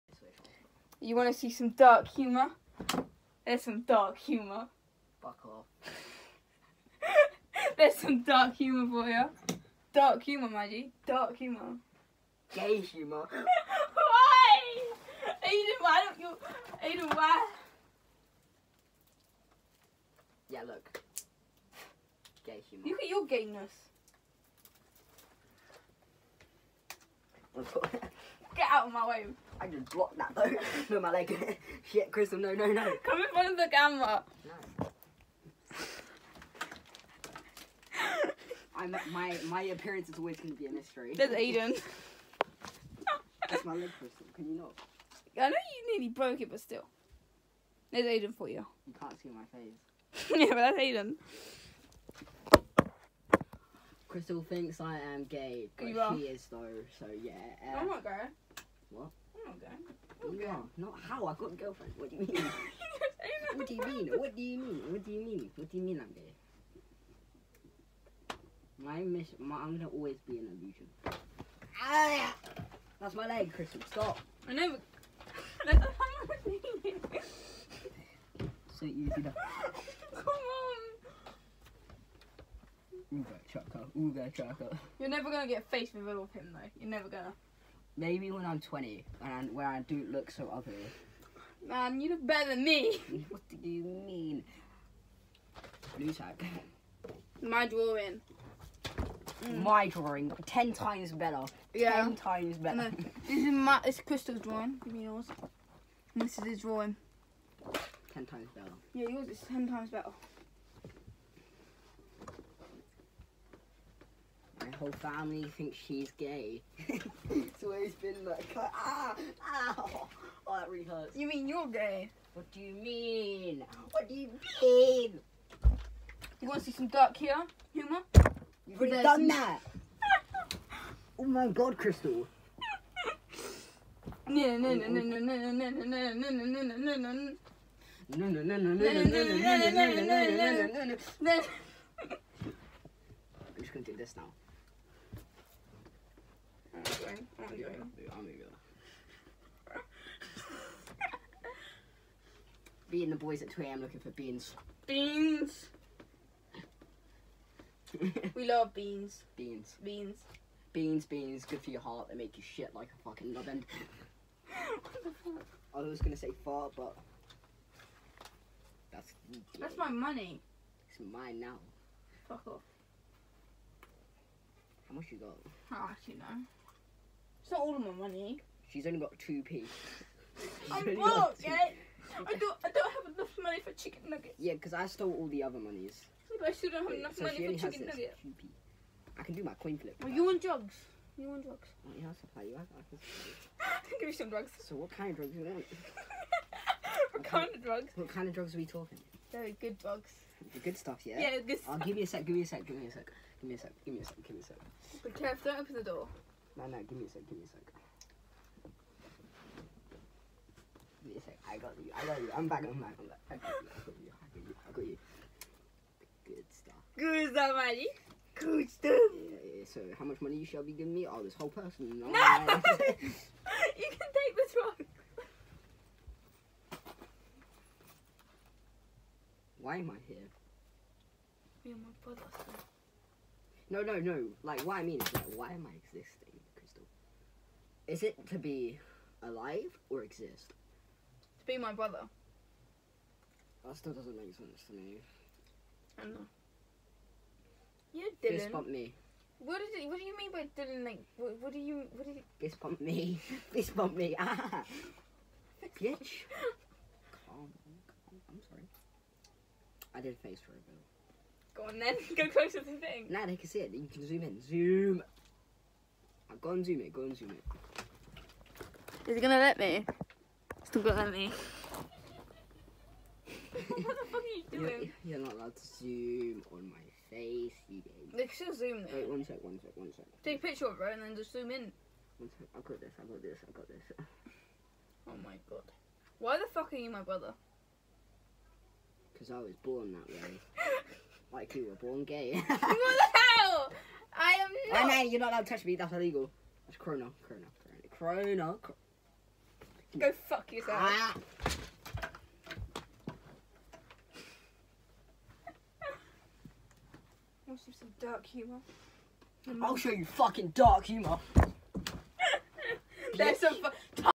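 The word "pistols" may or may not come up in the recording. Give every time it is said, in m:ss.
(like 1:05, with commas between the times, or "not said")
not said.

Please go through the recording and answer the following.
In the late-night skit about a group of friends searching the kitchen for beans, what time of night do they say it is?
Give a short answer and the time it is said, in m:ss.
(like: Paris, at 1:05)
2 am, at 2:33.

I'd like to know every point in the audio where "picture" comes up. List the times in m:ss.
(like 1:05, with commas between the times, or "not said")
4:40.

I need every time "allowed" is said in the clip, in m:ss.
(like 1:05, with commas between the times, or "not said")
4:35, 4:55.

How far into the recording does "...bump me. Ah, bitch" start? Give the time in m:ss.
4:13.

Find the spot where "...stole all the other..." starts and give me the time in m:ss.
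3:04.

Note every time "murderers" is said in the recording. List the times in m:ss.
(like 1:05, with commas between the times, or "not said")
not said.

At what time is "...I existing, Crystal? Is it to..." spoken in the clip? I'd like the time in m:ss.
3:55.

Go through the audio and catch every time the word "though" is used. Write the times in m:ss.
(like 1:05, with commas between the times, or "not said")
0:30, 0:56, 1:26, 4:38.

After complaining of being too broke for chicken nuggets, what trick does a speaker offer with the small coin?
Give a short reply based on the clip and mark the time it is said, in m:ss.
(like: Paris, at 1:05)
coin flip, at 3:09.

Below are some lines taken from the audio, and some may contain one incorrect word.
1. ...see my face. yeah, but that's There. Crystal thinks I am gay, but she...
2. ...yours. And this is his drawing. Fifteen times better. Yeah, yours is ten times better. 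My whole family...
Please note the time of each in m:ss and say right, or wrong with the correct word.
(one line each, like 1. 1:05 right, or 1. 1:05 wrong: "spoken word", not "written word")
1. 0:49 wrong: "Aiden", not "There"
2. 1:45 wrong: "Ten", not "Fifteen".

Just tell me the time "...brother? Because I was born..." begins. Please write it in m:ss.
4:47.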